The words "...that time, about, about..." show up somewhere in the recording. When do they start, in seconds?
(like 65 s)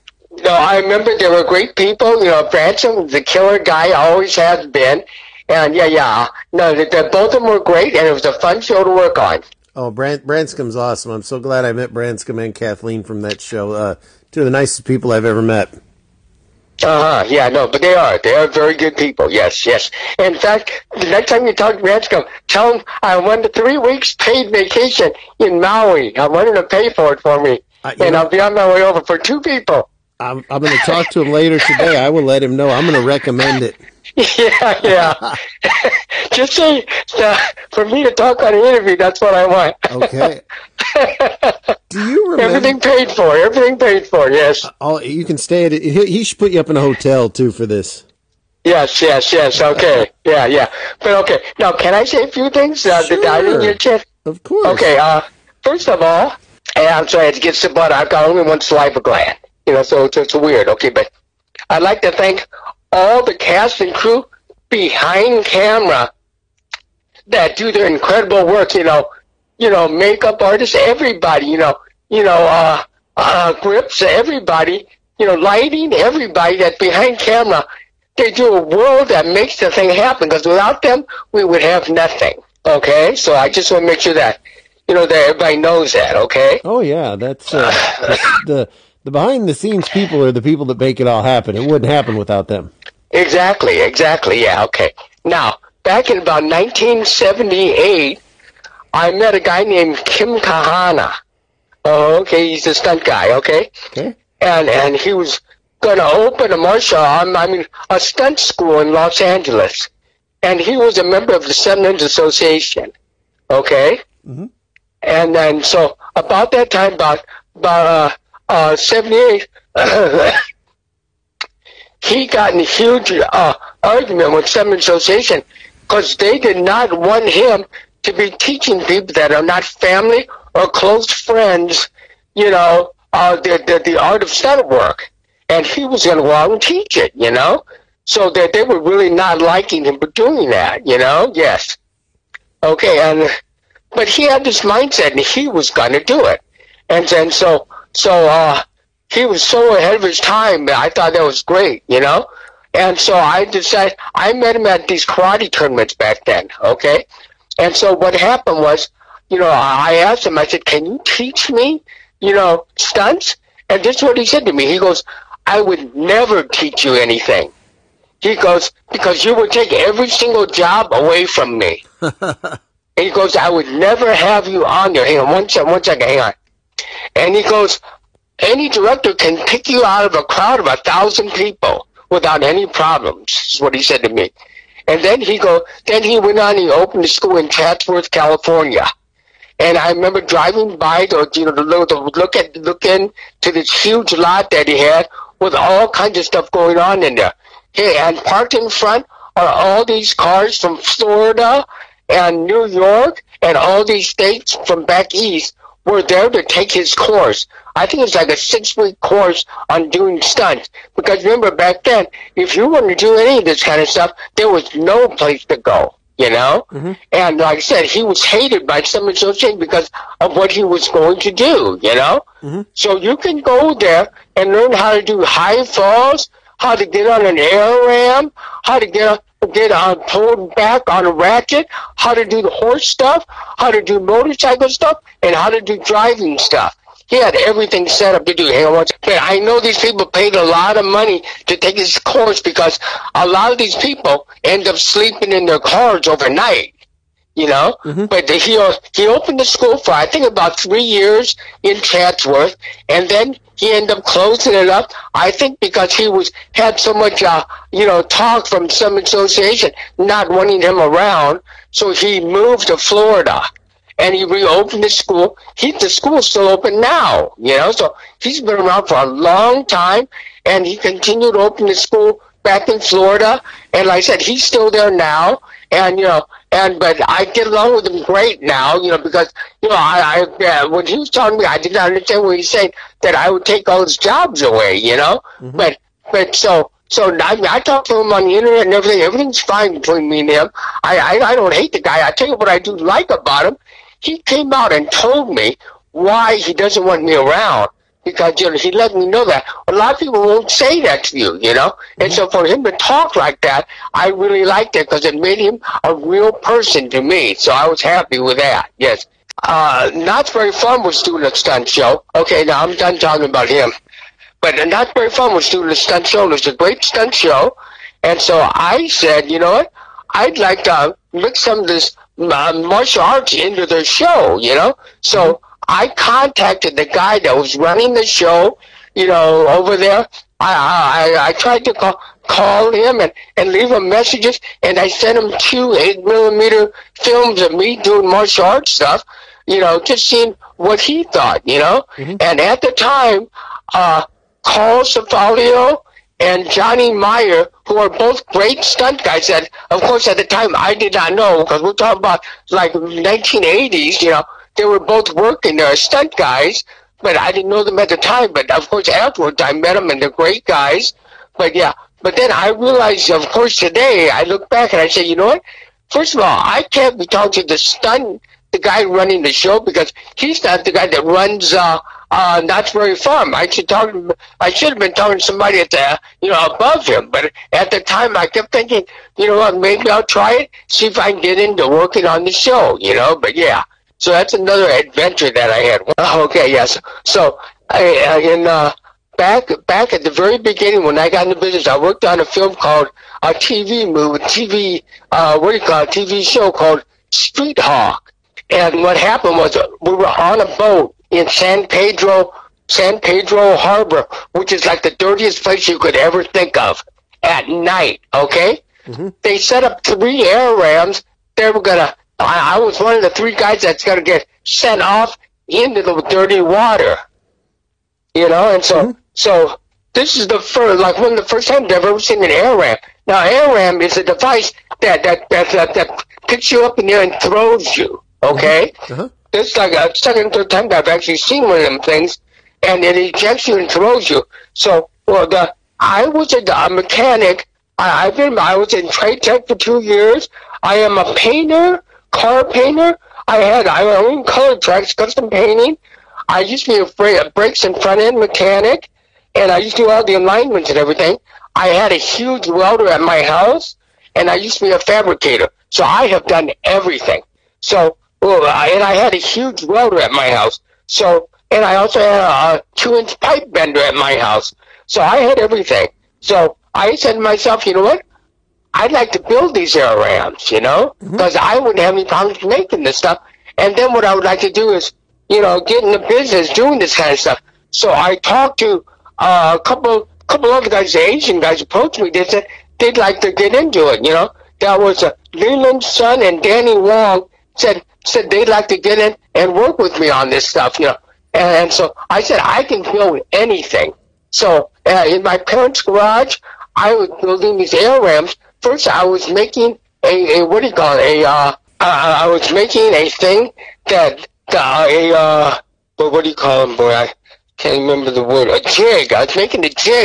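116 s.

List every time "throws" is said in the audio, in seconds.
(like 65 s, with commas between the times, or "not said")
427 s, 433 s.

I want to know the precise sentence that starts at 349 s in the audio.
And of course, at the time, I did not know because we're talking about like 1980s.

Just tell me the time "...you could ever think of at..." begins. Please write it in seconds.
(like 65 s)
405 s.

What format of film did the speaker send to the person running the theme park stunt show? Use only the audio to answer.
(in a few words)
8 millimeter.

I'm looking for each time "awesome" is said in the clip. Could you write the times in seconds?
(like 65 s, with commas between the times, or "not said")
10 s.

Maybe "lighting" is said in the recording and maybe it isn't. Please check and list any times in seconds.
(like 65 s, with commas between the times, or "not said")
75 s.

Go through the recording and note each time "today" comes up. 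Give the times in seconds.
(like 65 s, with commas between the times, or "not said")
31 s, 363 s.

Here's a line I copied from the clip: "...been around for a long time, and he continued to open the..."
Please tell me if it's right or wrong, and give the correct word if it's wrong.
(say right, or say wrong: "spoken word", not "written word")
right.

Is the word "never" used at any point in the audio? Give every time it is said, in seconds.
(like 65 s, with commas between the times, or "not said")
165 s, 173 s.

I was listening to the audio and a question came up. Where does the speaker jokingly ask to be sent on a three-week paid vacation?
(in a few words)
Maui.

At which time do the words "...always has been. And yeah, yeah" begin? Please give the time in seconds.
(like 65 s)
3 s.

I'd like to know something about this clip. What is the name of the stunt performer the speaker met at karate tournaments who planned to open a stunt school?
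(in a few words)
Kim Kahana.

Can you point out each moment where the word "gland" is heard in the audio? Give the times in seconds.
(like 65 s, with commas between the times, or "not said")
59 s.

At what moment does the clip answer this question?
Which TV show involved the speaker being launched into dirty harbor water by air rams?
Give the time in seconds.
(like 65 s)
397 s.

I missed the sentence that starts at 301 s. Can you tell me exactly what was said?
And so for him to talk like that, I really liked it because it made him a real person to me.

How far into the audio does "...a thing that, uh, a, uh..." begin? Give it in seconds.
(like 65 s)
502 s.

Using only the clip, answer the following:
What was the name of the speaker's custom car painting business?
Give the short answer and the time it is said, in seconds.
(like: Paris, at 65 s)
Color Tracks, at 444 s.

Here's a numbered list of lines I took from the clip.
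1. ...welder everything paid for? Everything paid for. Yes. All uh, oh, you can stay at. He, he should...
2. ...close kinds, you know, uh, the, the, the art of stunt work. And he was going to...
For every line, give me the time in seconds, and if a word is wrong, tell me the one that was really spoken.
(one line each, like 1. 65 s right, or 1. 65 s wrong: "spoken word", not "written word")
1. 42 s wrong: "remember", not "welder"
2. 130 s wrong: "friends", not "kinds".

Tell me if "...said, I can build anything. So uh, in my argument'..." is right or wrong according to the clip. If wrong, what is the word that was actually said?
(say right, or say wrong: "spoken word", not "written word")
wrong: "parents", not "argument".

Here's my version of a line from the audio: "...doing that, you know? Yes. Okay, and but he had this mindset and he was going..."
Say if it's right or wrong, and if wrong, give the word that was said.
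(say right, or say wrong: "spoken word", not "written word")
right.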